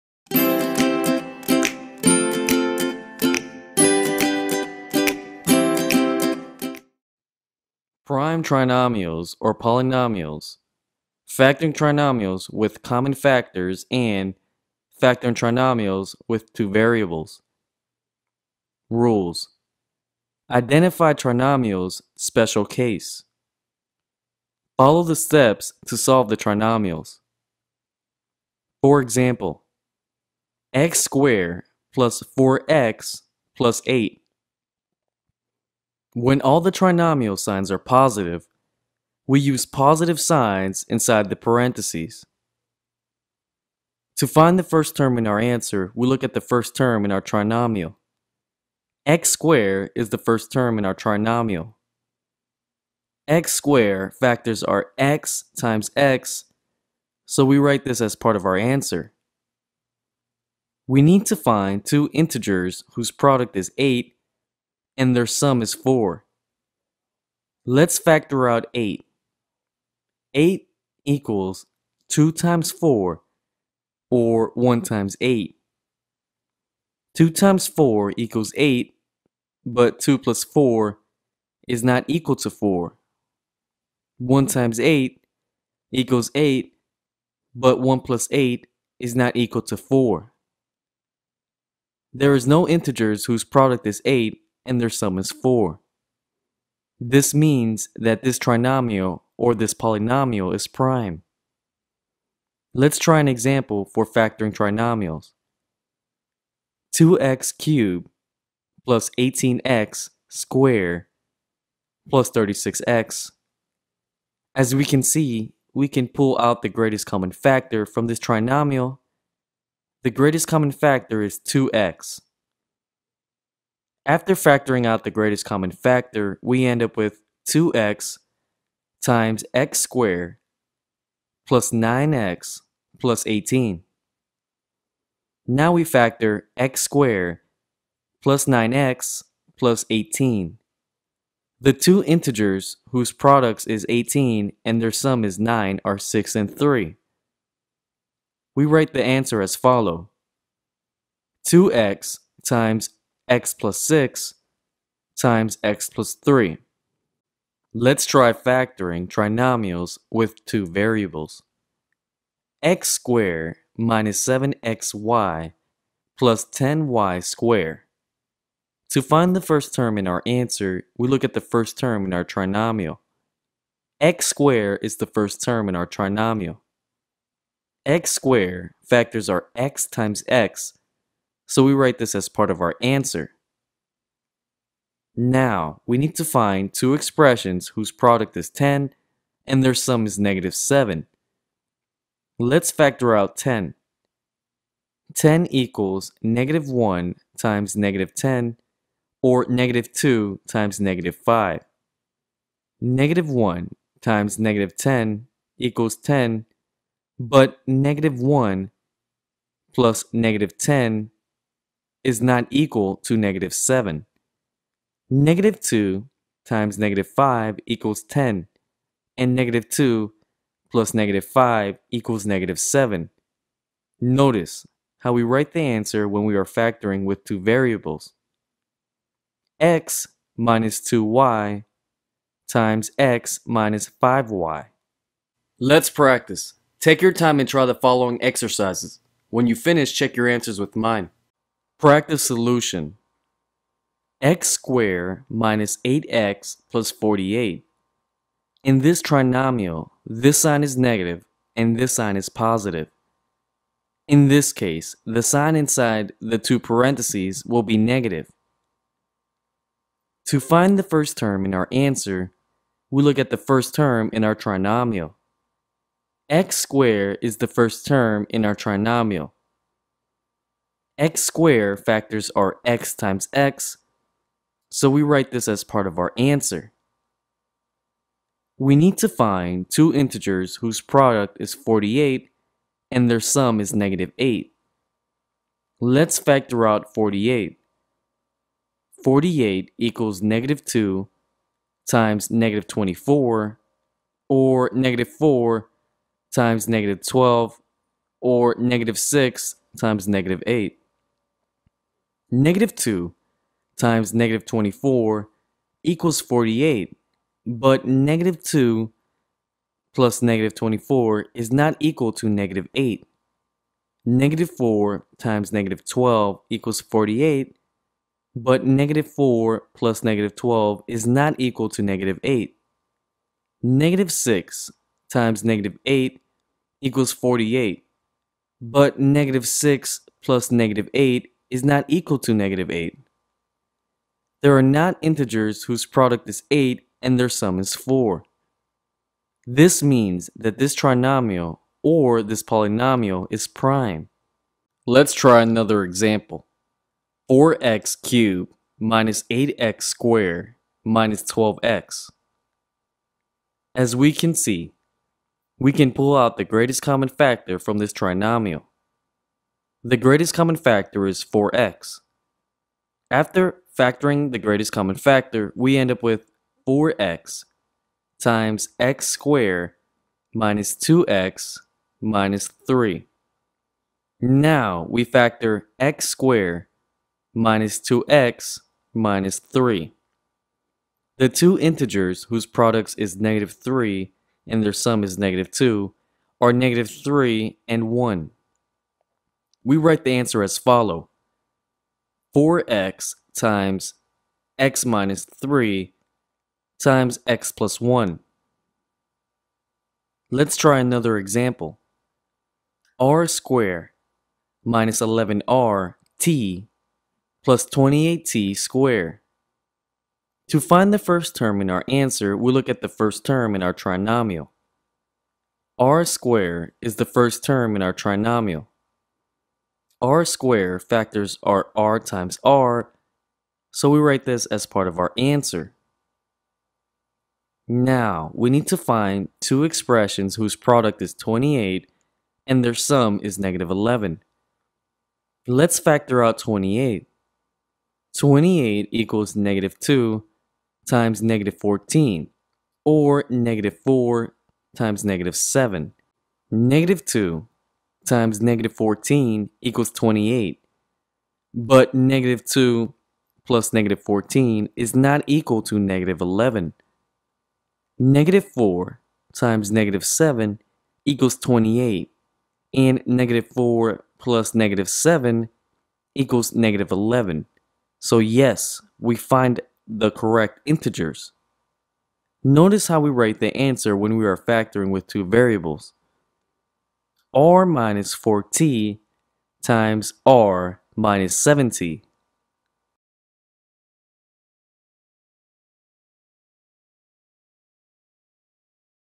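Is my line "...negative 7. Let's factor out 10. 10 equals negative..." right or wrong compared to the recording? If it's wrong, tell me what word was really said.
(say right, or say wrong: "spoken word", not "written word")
right.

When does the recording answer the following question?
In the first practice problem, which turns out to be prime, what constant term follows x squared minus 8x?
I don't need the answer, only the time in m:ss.
4:06.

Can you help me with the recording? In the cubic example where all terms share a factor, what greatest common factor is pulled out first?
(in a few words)
2x.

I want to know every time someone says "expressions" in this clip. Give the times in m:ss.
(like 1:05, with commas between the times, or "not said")
3:06, 7:09.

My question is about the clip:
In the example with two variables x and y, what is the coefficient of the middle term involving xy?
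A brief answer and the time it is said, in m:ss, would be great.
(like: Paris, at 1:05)
-7, at 2:43.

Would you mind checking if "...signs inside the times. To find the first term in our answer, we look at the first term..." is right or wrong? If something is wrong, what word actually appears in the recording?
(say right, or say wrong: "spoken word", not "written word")
wrong: "parentheses", not "times".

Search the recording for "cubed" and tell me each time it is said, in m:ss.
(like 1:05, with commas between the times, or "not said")
1:47, 5:48.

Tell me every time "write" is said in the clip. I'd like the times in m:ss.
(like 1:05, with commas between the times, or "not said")
0:57, 2:28, 3:01, 3:45, 4:35, 6:29, 7:03, 7:53.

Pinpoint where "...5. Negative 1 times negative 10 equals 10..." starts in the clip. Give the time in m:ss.
3:21.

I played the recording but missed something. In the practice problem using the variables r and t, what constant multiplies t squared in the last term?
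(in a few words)
28.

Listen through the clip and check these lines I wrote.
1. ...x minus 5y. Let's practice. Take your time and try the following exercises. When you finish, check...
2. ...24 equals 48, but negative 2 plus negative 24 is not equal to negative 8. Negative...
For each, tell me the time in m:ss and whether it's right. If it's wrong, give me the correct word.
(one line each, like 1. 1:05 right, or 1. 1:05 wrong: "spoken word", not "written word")
1. 3:52 right
2. 5:04 right.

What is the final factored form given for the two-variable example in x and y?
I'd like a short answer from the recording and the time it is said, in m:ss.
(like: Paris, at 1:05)
(x - 2y)(x - 5y), at 3:49.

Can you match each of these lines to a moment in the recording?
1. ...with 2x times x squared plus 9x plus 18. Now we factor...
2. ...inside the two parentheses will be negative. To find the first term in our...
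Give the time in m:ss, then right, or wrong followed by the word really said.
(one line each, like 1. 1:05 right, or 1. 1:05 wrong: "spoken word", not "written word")
1. 2:06 right
2. 4:15 right.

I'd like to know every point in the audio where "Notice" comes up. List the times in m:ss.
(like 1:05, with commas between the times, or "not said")
3:43, 7:52.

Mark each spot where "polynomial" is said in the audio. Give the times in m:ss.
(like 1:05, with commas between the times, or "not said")
0:09, 1:39, 5:42.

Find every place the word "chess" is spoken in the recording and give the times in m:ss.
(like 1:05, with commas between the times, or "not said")
not said.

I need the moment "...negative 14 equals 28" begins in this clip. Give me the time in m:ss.
7:28.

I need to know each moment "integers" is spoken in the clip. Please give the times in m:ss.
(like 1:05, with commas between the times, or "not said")
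1:02, 1:32, 2:22, 4:39, 5:35, 6:21, 7:50.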